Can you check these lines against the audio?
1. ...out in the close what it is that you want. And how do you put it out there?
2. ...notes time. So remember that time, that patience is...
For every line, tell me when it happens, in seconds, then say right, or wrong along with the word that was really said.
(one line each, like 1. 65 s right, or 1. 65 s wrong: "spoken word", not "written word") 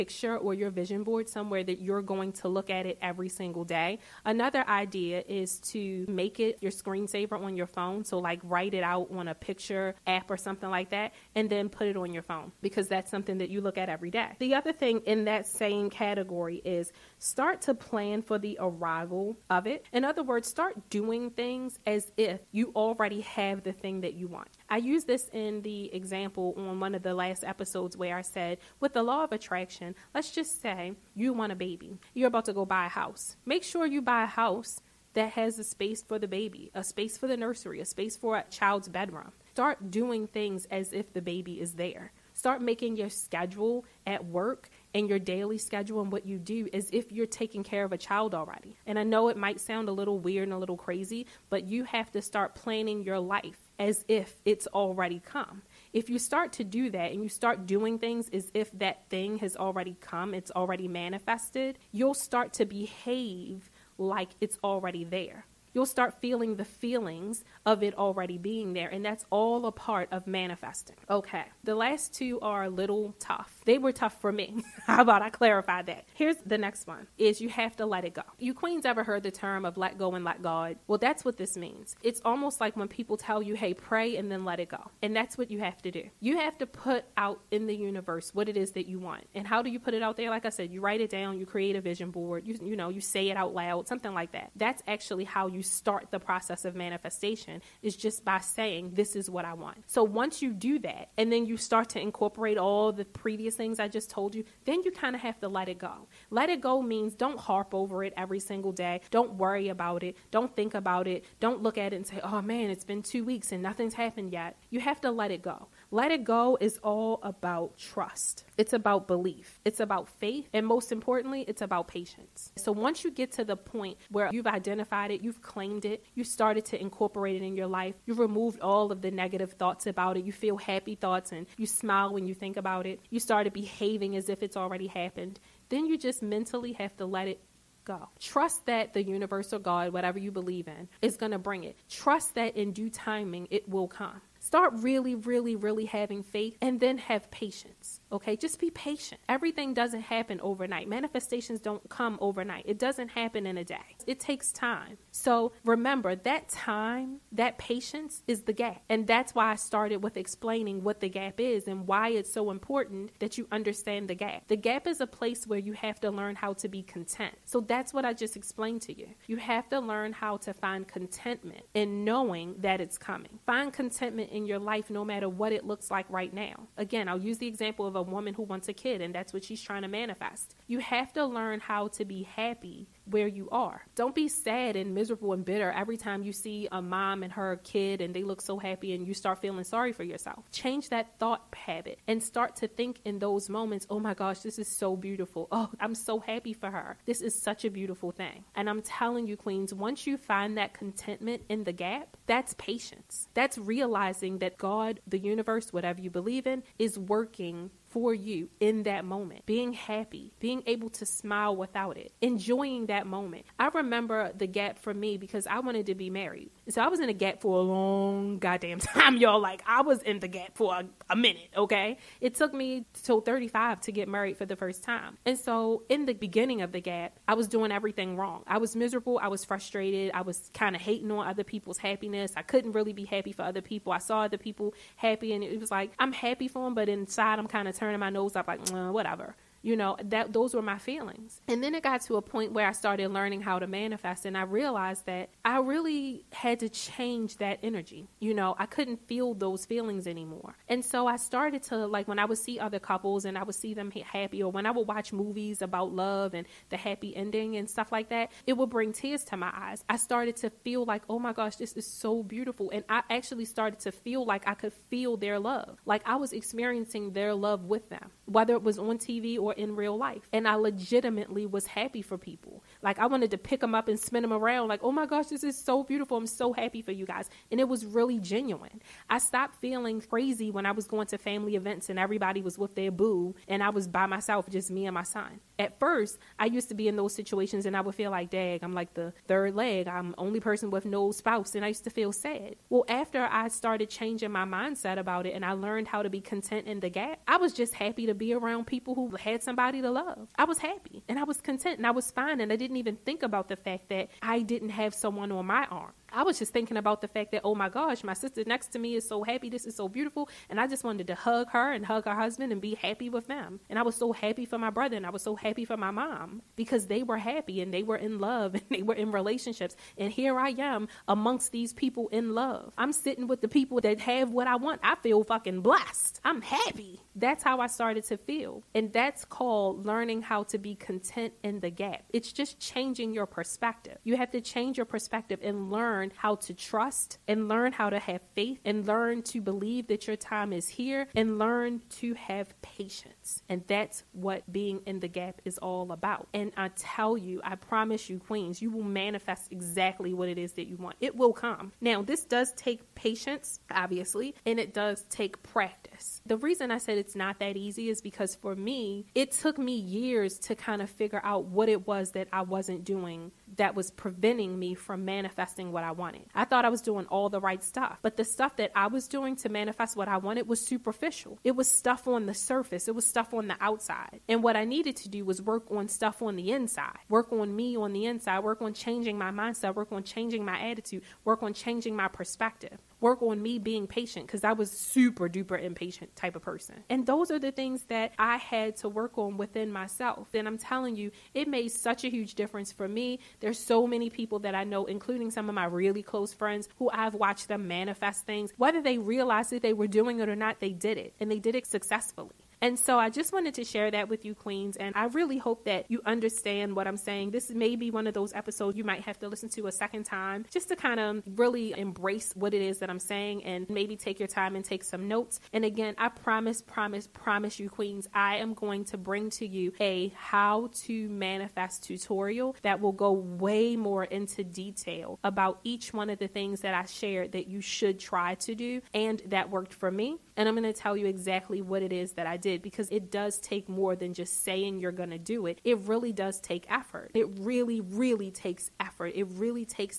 1. 87 s wrong: "universe", not "close"
2. 154 s wrong: "takes", not "notes".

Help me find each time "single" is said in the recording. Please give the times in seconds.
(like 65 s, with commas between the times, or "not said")
3 s, 108 s.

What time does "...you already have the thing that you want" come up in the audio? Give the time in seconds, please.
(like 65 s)
22 s.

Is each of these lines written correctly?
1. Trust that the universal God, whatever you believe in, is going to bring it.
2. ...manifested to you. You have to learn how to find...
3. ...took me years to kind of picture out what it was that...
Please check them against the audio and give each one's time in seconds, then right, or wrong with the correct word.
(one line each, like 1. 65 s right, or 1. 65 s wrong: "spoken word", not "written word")
1. 138 s right
2. 168 s wrong: "explained", not "manifested"
3. 359 s wrong: "figure", not "picture".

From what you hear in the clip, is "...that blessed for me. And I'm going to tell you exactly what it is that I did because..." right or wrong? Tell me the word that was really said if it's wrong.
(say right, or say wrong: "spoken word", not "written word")
wrong: "worked", not "blessed".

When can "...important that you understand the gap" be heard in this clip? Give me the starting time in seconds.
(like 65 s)
162 s.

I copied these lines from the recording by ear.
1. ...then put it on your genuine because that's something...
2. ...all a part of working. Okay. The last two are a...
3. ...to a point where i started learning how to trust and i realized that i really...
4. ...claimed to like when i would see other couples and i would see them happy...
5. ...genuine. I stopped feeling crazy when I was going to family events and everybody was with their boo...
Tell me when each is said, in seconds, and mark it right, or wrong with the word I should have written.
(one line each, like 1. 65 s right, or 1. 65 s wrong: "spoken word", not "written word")
1. 11 s wrong: "phone", not "genuine"
2. 69 s wrong: "manifesting", not "working"
3. 242 s wrong: "manifest", not "trust"
4. 251 s wrong: "started", not "claimed"
5. 278 s right.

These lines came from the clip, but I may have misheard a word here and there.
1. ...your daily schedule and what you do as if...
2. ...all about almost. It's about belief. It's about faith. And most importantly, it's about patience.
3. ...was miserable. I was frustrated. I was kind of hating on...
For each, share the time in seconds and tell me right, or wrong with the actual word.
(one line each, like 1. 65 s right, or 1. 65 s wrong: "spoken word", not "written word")
1. 45 s right
2. 116 s wrong: "trust", not "almost"
3. 228 s right.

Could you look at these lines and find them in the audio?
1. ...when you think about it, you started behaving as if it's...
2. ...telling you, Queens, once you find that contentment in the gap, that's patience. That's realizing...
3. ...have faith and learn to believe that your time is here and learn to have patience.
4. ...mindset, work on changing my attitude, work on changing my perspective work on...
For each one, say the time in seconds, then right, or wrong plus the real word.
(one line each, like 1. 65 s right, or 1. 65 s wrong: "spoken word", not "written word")
1. 132 s right
2. 198 s right
3. 337 s right
4. 379 s right.